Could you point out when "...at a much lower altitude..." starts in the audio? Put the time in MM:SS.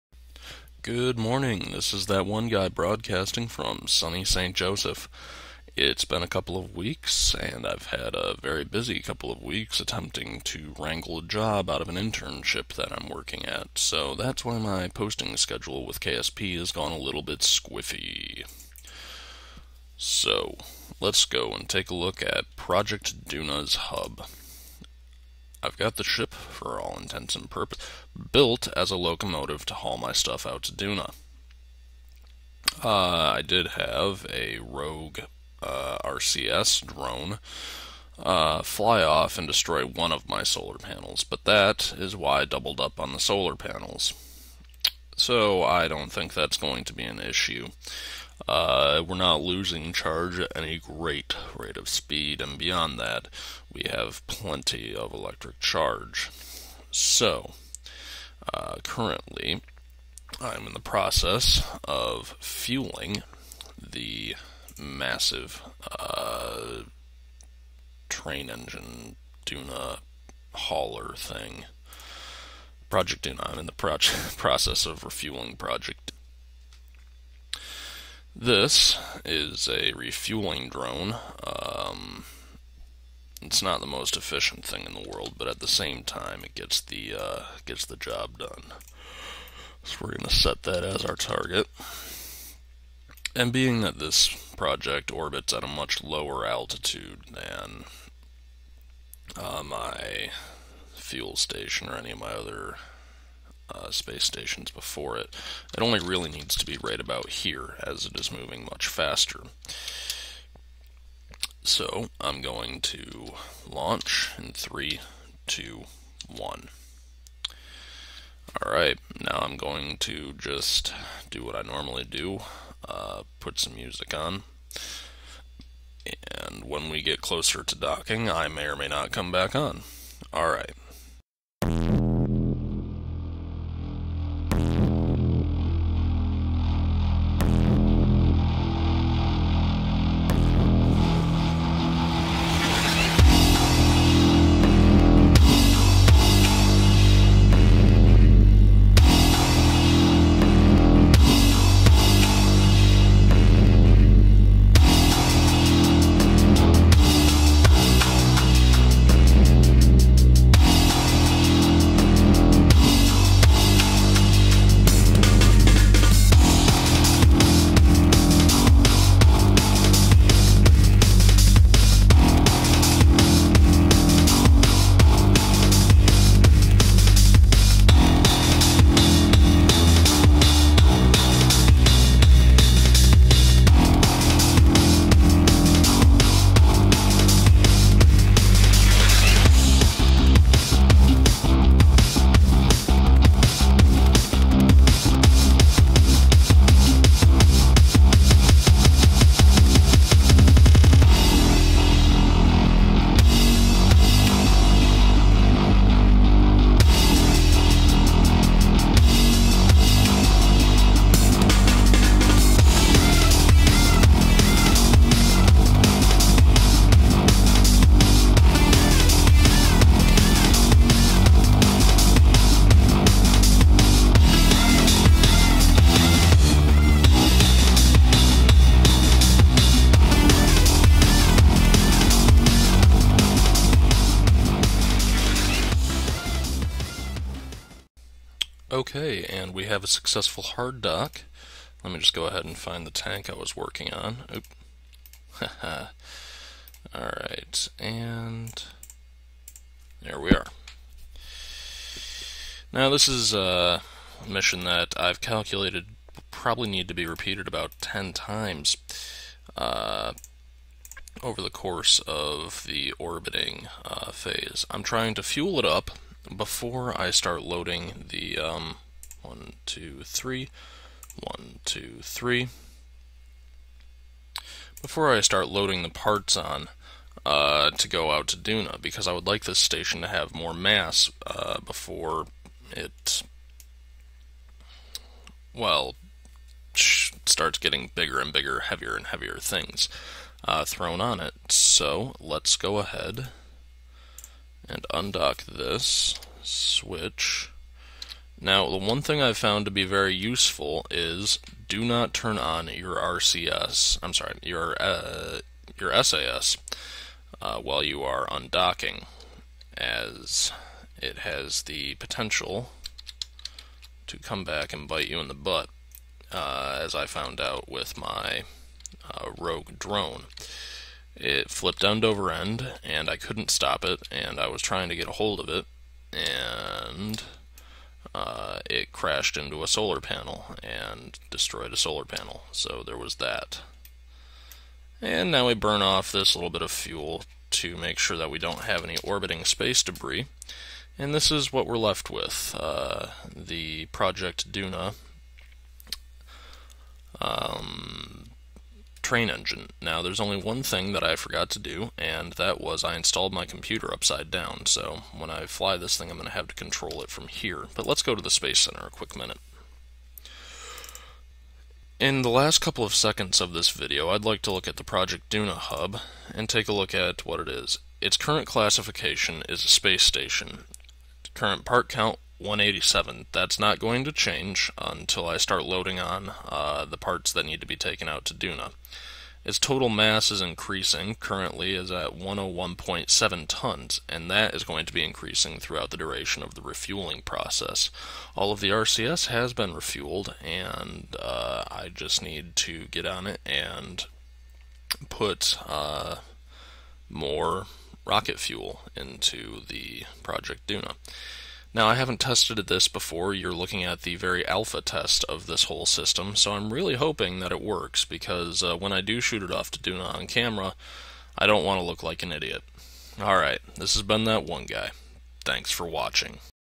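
01:35.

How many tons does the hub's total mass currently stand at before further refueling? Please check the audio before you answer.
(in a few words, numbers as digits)
101.7 tons.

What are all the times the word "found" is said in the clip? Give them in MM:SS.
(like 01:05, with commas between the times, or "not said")
04:59, 05:17.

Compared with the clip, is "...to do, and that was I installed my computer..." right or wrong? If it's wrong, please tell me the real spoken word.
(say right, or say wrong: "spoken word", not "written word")
right.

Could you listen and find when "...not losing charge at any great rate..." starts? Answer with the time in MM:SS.
00:49.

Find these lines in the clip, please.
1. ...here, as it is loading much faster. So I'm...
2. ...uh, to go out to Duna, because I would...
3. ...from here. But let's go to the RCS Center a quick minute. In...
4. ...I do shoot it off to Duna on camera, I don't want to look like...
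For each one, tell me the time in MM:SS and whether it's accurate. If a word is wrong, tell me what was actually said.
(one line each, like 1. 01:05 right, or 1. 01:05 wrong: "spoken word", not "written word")
1. 01:47 wrong: "moving", not "loading"
2. 04:37 right
3. 05:57 wrong: "Space", not "RCS"
4. 06:48 right.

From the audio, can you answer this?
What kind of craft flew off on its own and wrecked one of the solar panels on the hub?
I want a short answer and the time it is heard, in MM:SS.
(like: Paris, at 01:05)
RCS drone, at 00:36.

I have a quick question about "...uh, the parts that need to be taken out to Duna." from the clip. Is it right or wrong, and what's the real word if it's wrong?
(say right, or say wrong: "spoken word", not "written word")
right.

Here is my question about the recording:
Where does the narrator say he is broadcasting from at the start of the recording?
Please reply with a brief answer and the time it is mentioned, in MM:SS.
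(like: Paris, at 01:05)
St. Joseph, at 00:04.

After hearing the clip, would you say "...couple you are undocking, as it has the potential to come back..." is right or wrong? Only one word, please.
wrong.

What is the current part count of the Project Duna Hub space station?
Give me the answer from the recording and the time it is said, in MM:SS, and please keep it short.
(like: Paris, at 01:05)
187, at 06:12.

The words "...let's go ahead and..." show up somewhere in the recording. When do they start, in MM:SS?
04:52.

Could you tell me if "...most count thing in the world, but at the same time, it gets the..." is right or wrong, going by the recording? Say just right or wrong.
wrong.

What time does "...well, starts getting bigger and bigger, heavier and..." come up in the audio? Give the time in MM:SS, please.
04:45.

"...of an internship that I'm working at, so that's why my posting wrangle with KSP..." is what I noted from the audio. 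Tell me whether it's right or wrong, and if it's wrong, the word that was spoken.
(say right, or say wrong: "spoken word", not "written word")
wrong: "schedule", not "wrangle".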